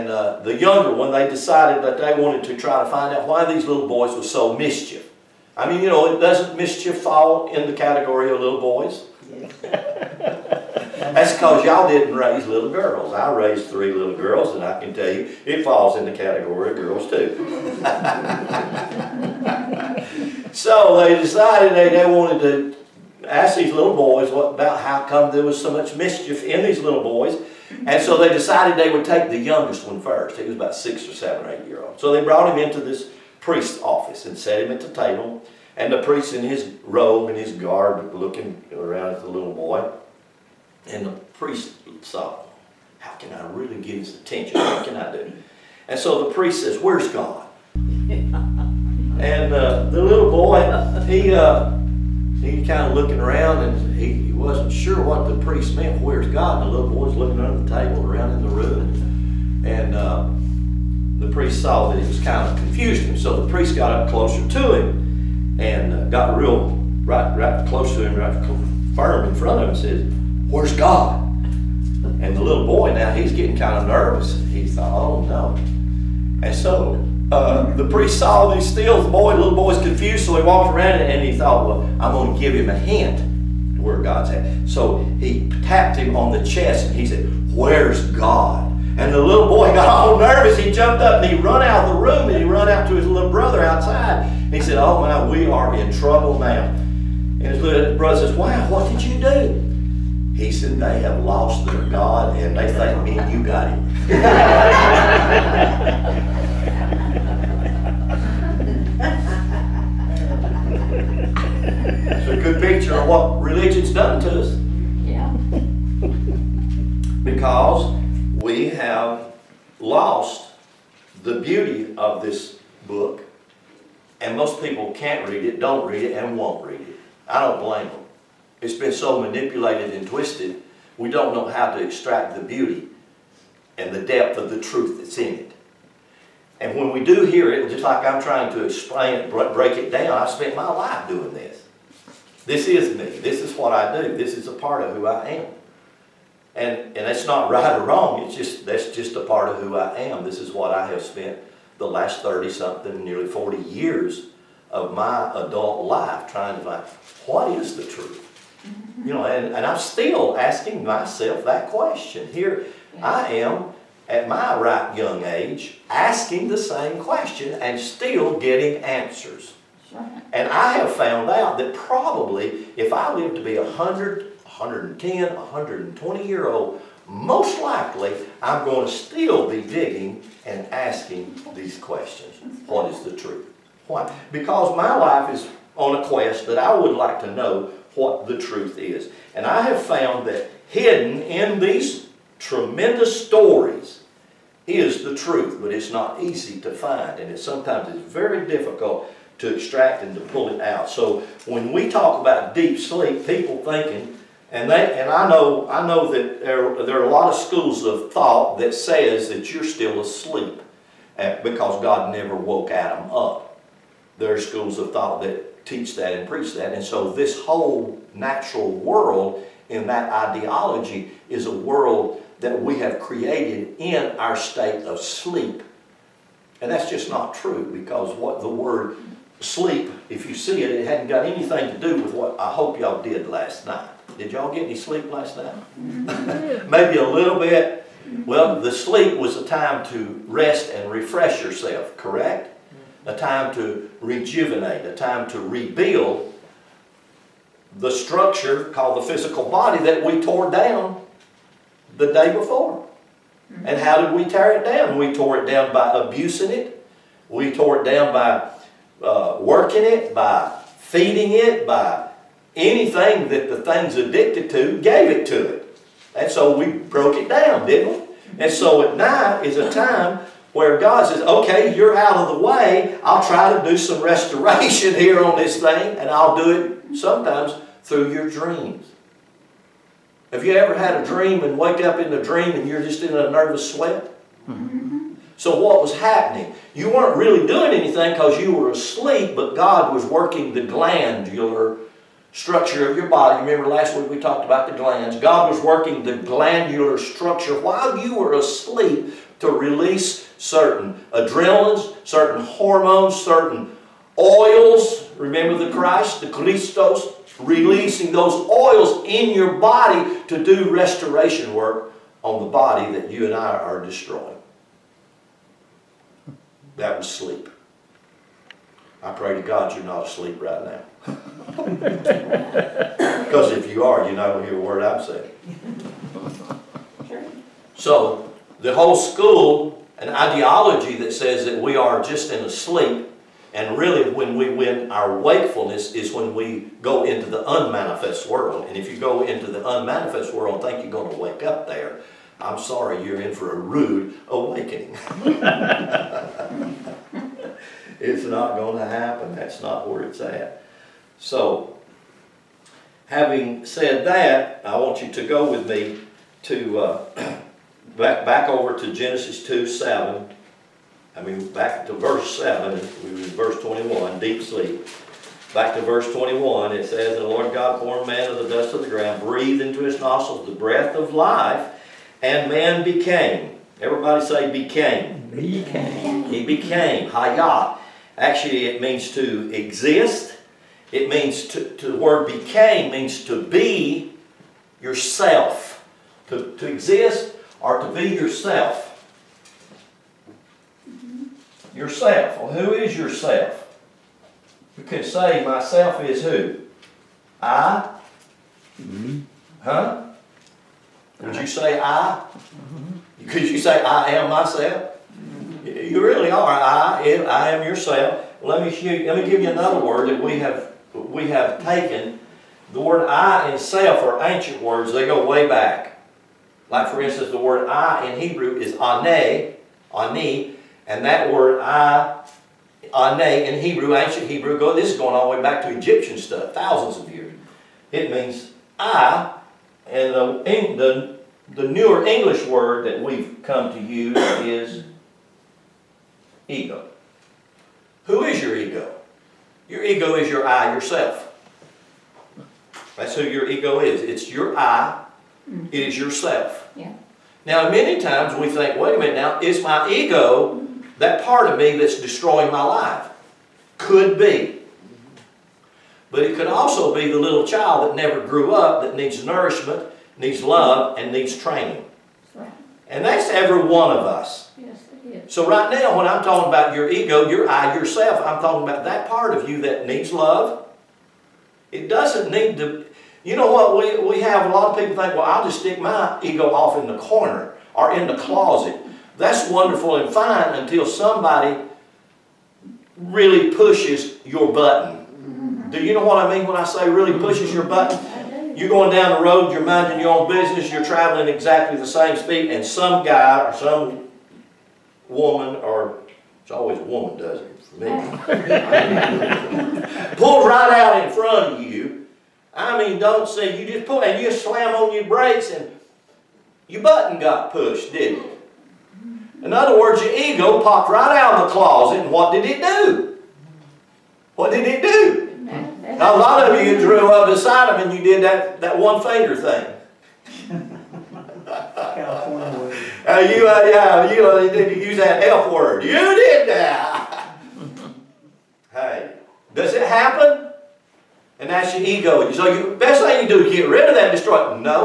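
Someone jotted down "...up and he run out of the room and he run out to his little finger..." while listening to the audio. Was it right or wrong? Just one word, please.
wrong.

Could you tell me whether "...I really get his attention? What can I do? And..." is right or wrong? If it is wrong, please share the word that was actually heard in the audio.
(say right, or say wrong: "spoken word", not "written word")
right.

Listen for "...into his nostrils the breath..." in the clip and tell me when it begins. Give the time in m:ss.
6:09.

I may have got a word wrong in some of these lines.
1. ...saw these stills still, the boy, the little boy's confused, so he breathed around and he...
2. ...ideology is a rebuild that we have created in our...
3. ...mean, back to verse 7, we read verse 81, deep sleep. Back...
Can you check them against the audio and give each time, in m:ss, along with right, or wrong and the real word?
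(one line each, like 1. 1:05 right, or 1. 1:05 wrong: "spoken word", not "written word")
1. 1:18 wrong: "walked", not "breathed"
2. 3:40 wrong: "world", not "rebuild"
3. 6:01 wrong: "21", not "81".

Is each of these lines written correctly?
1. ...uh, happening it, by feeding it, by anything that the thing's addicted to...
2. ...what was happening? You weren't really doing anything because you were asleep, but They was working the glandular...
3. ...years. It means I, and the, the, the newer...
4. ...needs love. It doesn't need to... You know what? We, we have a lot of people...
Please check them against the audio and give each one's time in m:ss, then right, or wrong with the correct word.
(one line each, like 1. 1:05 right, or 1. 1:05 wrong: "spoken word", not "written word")
1. 4:19 wrong: "working", not "happening"
2. 4:45 wrong: "God", not "They"
3. 7:07 right
4. 7:49 right.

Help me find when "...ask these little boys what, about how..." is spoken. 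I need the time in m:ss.
0:23.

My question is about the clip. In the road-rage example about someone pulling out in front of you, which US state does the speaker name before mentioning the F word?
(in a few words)
California.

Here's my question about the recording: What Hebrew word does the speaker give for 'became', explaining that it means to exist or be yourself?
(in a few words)
Hayat.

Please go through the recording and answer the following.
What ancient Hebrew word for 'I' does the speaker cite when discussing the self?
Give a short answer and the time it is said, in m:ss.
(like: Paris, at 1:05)
Ani, at 6:59.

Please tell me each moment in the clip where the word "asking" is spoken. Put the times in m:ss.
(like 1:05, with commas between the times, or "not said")
2:40, 2:45, 3:00.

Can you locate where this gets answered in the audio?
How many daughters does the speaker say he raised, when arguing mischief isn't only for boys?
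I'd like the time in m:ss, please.
0:13.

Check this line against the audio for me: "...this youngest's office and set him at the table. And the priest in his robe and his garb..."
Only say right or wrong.
wrong.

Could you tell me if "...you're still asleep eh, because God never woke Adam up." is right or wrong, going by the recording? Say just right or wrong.
right.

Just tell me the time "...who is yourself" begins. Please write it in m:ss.
6:32.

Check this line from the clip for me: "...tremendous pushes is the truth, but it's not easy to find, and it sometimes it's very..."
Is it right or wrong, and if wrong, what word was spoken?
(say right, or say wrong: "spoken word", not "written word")
wrong: "stories", not "pushes".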